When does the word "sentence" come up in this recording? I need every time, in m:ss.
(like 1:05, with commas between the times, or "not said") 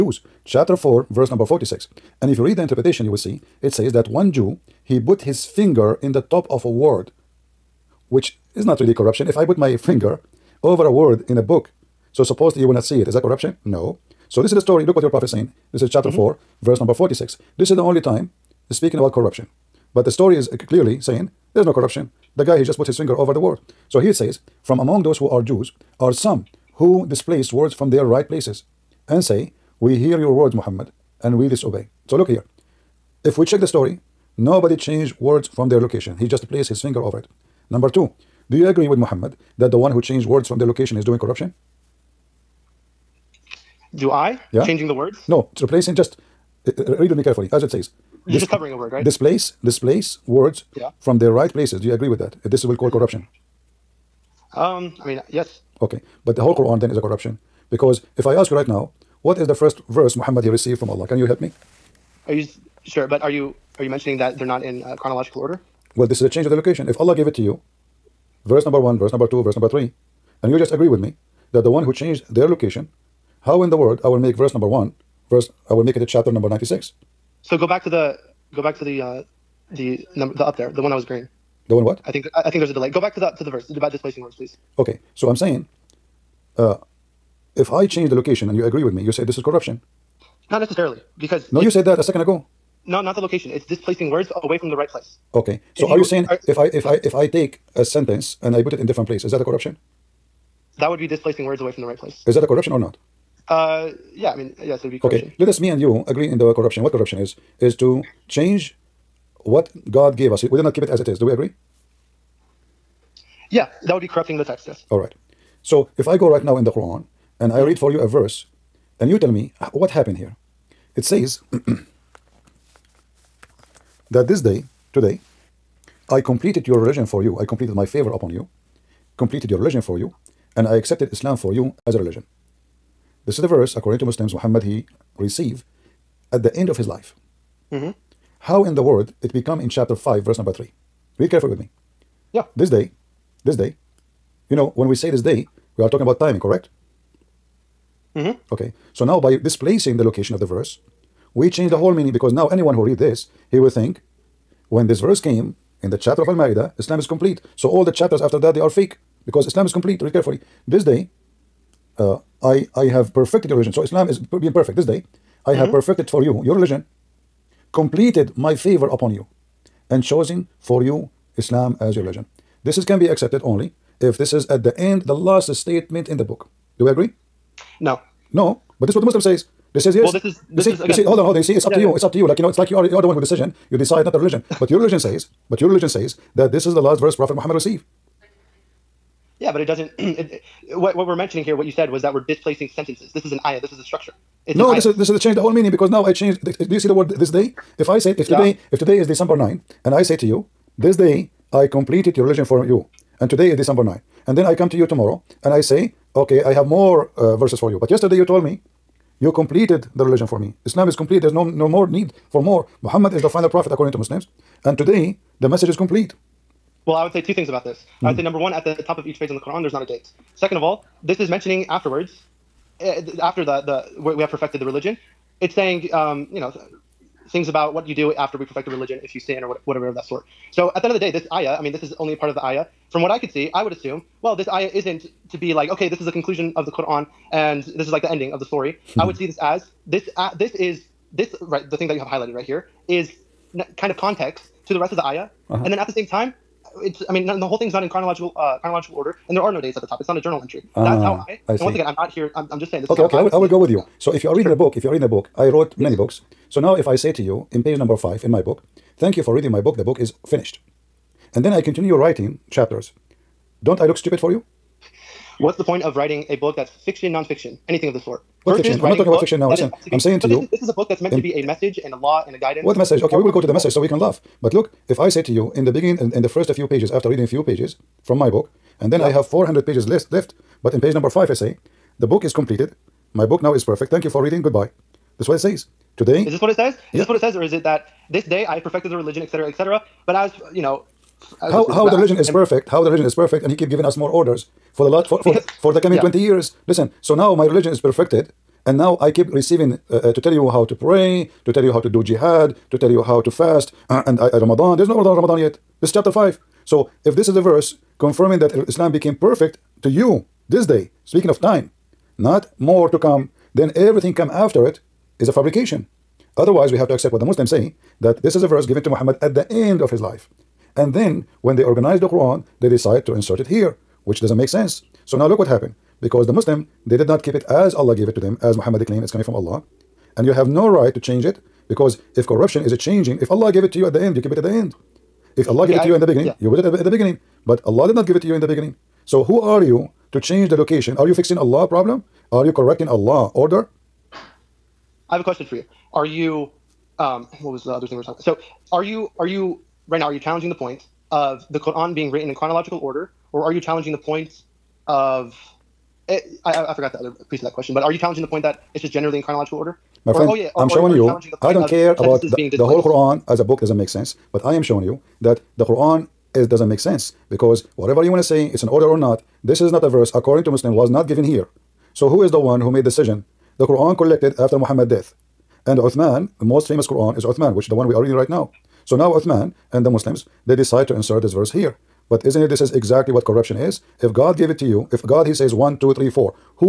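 1:37, 3:12.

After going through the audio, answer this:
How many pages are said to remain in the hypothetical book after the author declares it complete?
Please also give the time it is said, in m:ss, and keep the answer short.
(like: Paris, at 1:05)
400, at 4:39.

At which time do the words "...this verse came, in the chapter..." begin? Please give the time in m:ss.
2:34.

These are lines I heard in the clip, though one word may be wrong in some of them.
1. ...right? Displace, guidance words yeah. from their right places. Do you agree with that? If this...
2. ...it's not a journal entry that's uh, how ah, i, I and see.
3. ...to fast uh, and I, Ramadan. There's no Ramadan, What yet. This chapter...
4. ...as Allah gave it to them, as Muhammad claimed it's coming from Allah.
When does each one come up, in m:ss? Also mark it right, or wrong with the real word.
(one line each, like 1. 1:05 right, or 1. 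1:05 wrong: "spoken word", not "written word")
1. 0:48 wrong: "displace", not "guidance"
2. 4:10 right
3. 5:03 wrong: "Ramadan", not "What"
4. 5:27 right.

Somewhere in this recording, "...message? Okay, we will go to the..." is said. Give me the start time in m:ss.
4:32.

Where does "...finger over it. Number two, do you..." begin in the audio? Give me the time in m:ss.
0:36.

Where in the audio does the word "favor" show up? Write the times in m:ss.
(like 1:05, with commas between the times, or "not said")
2:07, 2:48.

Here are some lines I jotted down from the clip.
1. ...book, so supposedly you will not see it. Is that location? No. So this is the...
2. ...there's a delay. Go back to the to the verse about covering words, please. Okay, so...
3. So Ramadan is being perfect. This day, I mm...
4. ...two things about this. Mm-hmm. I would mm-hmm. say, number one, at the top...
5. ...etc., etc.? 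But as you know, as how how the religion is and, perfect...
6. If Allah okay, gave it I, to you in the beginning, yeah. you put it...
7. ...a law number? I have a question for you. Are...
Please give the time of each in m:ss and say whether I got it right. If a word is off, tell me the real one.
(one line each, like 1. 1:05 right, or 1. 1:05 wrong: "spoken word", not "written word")
1. 0:11 wrong: "corruption", not "location"
2. 1:22 wrong: "displacing", not "covering"
3. 2:43 wrong: "Islam", not "Ramadan"
4. 3:37 right
5. 4:49 right
6. 5:35 right
7. 5:42 wrong: "order", not "number".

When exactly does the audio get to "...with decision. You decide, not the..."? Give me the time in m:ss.
3:03.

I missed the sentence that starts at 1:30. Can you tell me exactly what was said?
Not necessarily, because no, you said that a second ago.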